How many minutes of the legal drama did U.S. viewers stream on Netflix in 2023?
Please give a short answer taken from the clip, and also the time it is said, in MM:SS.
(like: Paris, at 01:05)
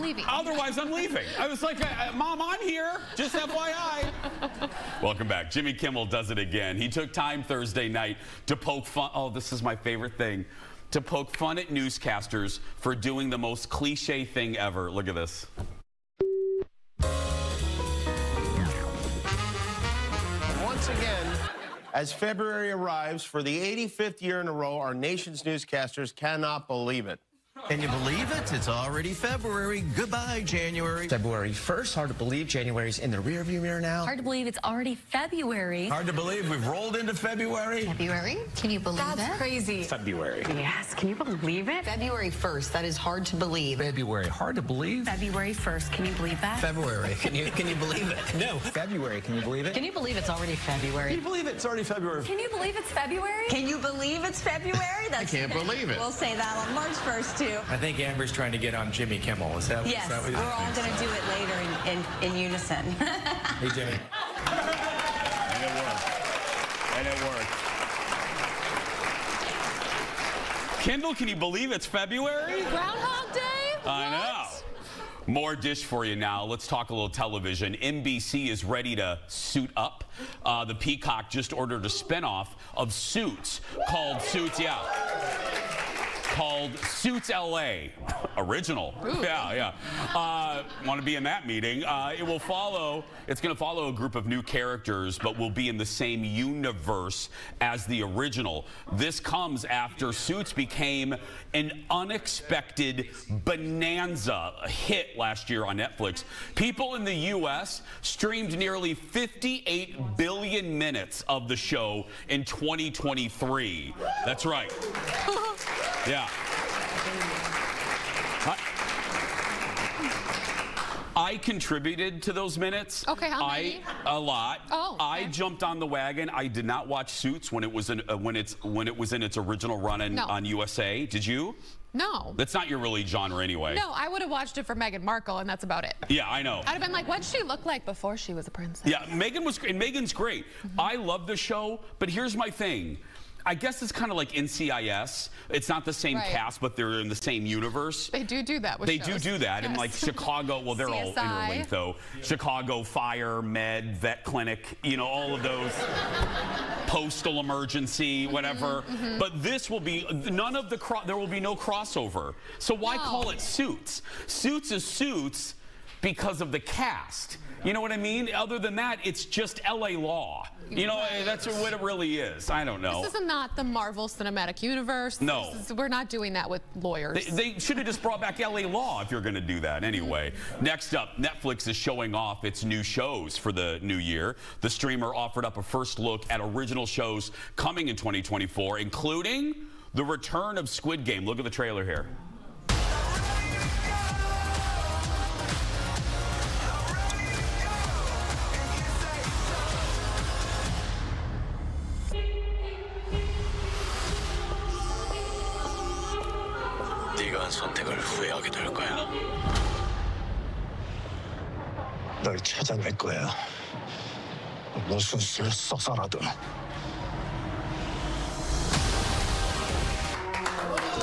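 nearly 58 billion, at 01:48.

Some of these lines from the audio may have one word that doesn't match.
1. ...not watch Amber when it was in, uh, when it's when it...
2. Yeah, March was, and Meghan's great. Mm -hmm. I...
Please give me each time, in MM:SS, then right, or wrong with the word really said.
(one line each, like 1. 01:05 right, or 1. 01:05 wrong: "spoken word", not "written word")
1. 02:06 wrong: "Suits", not "Amber"
2. 02:18 wrong: "Meghan", not "March".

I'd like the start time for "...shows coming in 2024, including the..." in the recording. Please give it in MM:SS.
03:06.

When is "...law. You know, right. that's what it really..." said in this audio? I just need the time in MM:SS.
02:49.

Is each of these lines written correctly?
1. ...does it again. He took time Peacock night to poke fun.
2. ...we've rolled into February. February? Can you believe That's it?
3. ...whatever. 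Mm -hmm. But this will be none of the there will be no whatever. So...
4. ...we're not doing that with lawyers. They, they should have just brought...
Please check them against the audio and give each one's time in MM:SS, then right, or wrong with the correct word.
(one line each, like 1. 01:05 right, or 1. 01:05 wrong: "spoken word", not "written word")
1. 00:06 wrong: "Thursday", not "Peacock"
2. 00:36 right
3. 02:38 wrong: "crossover", not "whatever"
4. 02:55 right.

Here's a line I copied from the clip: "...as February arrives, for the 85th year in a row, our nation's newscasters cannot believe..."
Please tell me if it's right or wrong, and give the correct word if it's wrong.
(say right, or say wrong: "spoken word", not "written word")
right.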